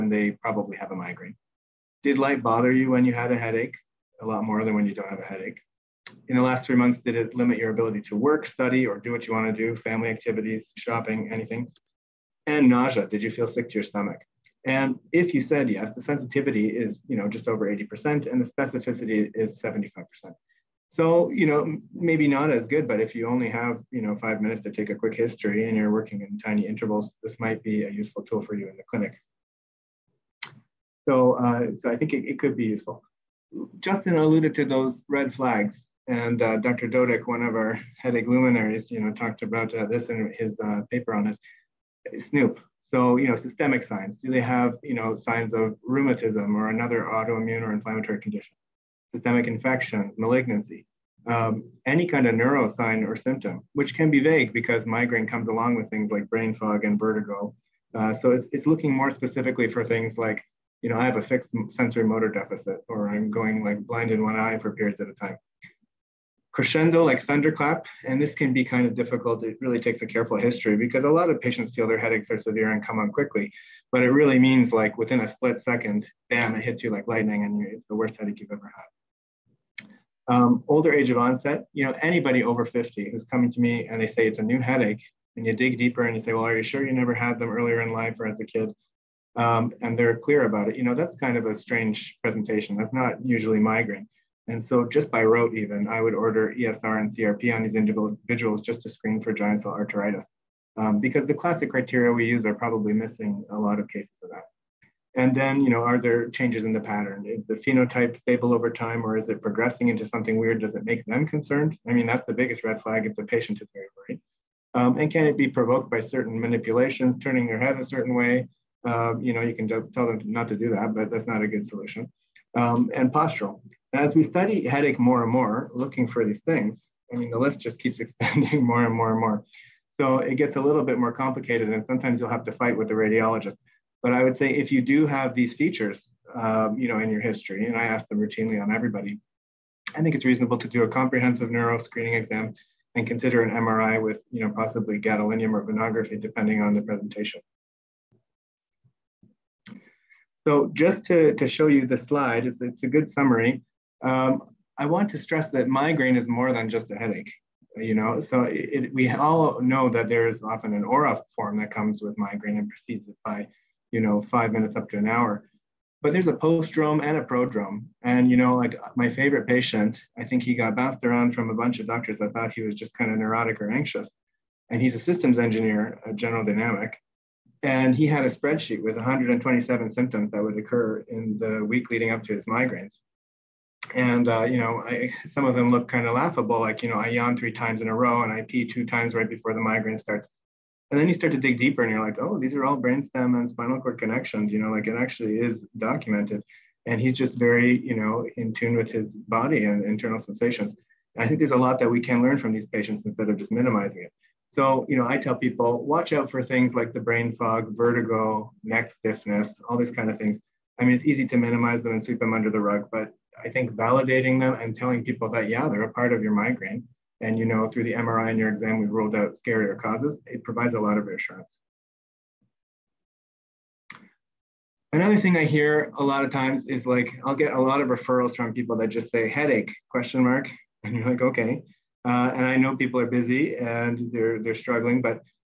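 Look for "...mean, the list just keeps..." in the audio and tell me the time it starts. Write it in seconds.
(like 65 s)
127 s.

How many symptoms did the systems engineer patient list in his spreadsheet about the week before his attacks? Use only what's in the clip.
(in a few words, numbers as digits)
127.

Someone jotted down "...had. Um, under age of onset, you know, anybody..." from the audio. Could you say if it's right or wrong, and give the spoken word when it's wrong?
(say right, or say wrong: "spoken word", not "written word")
wrong: "older", not "under".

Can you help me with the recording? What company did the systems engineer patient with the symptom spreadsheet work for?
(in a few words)
General Dynamic.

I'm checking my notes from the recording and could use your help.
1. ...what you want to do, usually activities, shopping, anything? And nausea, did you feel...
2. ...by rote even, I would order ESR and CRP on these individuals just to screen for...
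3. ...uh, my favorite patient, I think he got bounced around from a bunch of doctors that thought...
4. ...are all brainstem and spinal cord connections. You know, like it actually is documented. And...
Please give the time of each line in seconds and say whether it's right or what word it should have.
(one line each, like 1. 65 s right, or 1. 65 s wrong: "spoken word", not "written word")
1. 9 s wrong: "family", not "usually"
2. 95 s right
3. 168 s right
4. 192 s right.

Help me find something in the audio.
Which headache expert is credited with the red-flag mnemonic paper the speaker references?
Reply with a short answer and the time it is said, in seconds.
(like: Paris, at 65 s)
Dr. Dodick, at 36 s.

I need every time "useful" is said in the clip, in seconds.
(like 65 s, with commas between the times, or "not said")
27 s, 32 s.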